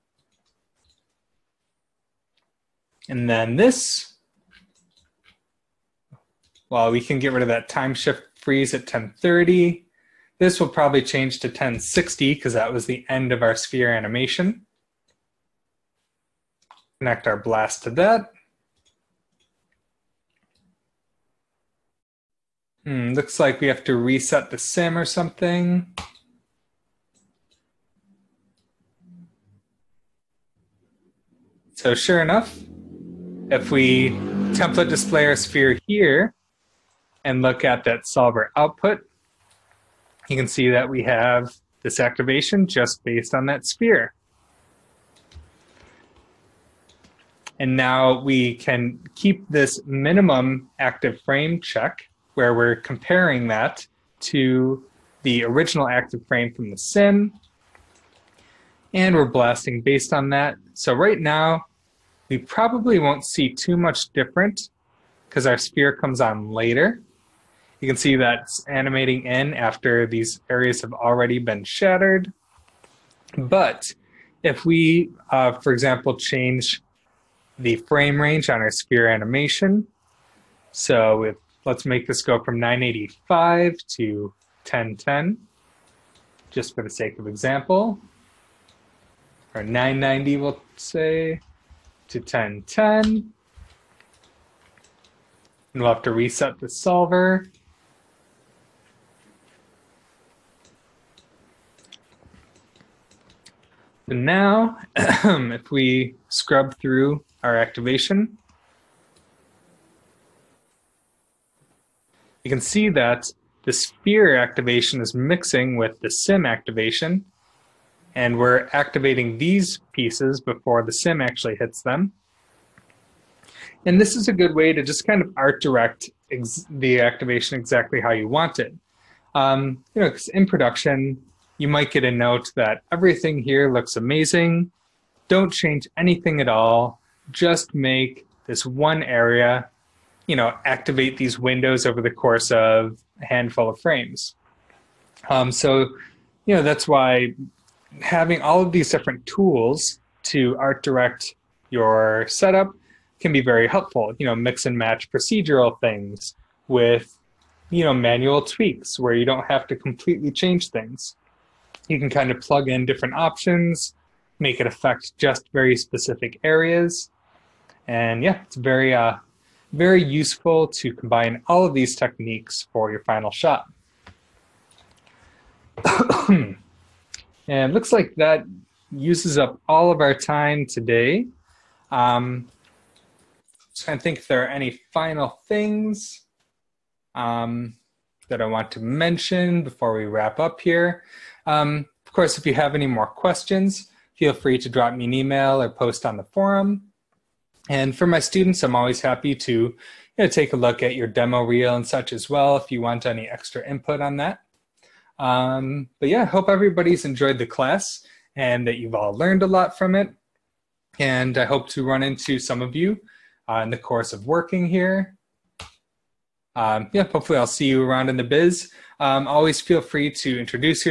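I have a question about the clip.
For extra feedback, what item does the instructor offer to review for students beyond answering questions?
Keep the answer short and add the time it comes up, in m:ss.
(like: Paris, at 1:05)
demo reel, at 3:21.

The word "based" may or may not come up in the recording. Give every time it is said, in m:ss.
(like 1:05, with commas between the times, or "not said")
0:43, 0:59.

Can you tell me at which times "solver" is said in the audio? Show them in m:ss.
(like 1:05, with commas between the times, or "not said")
0:38, 1:36.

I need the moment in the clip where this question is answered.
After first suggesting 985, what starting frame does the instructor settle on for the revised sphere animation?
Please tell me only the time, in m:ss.
1:29.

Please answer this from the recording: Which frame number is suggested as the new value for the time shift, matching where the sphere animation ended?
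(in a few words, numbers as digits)
1060.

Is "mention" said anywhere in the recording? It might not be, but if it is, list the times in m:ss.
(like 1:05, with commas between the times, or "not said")
3:08.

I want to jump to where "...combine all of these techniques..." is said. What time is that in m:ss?
2:50.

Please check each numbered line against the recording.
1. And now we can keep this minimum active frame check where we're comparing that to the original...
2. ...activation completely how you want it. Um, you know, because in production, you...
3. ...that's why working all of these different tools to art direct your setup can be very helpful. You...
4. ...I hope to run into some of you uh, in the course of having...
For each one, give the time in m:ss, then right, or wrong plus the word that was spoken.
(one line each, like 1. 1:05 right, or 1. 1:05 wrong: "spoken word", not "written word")
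1. 0:47 right
2. 2:06 wrong: "exactly", not "completely"
3. 2:26 wrong: "having", not "working"
4. 3:31 wrong: "working", not "having".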